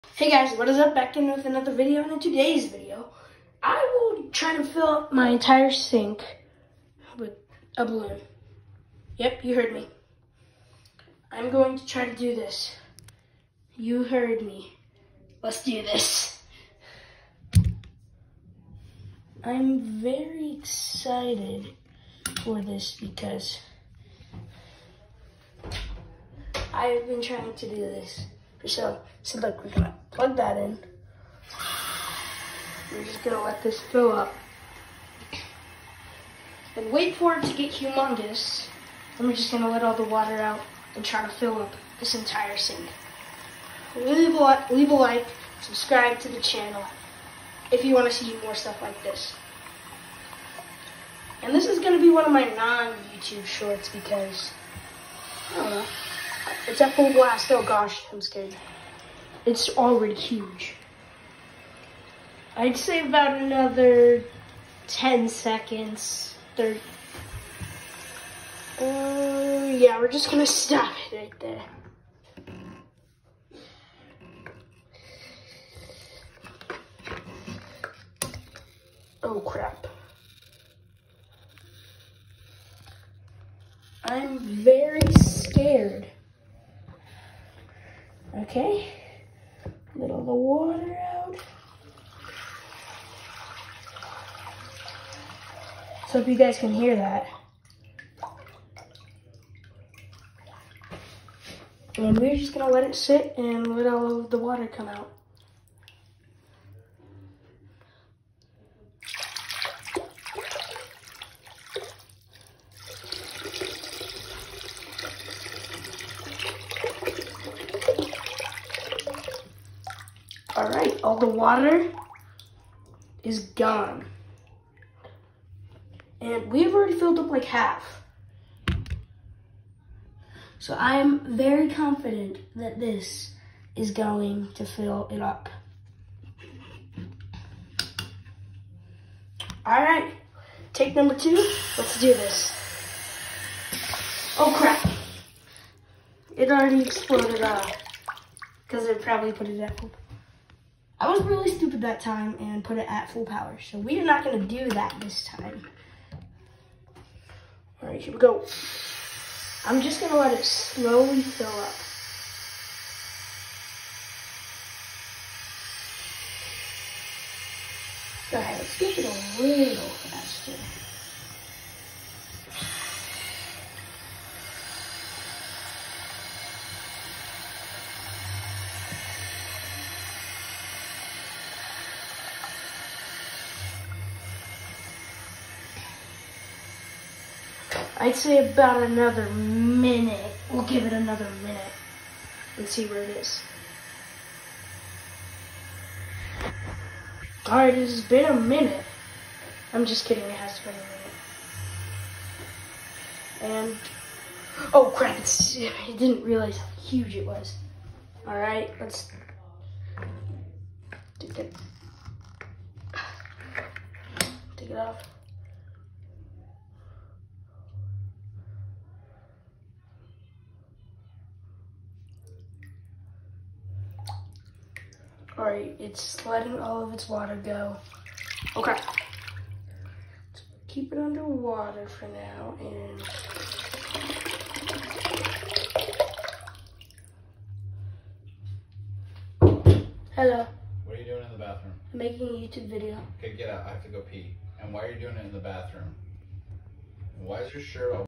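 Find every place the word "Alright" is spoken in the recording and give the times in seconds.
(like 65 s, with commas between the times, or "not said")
197 s, 208 s.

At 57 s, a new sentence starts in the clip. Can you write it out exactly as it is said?
Oh gosh, I'm scared it's already huge.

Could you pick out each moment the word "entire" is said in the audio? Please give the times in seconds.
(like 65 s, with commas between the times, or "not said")
5 s, 42 s.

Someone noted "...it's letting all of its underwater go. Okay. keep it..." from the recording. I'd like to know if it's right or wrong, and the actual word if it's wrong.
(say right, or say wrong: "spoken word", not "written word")
wrong: "water", not "underwater".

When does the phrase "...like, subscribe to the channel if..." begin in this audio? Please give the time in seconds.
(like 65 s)
44 s.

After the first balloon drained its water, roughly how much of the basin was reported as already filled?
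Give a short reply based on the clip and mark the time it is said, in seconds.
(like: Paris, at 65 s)
half, at 127 s.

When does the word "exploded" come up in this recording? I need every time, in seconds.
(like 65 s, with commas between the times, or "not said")
146 s.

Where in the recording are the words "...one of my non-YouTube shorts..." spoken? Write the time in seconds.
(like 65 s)
52 s.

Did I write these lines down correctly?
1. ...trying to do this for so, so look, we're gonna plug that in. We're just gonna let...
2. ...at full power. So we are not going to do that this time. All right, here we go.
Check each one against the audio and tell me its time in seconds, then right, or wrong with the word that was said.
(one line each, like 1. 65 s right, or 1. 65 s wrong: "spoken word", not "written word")
1. 27 s right
2. 152 s right.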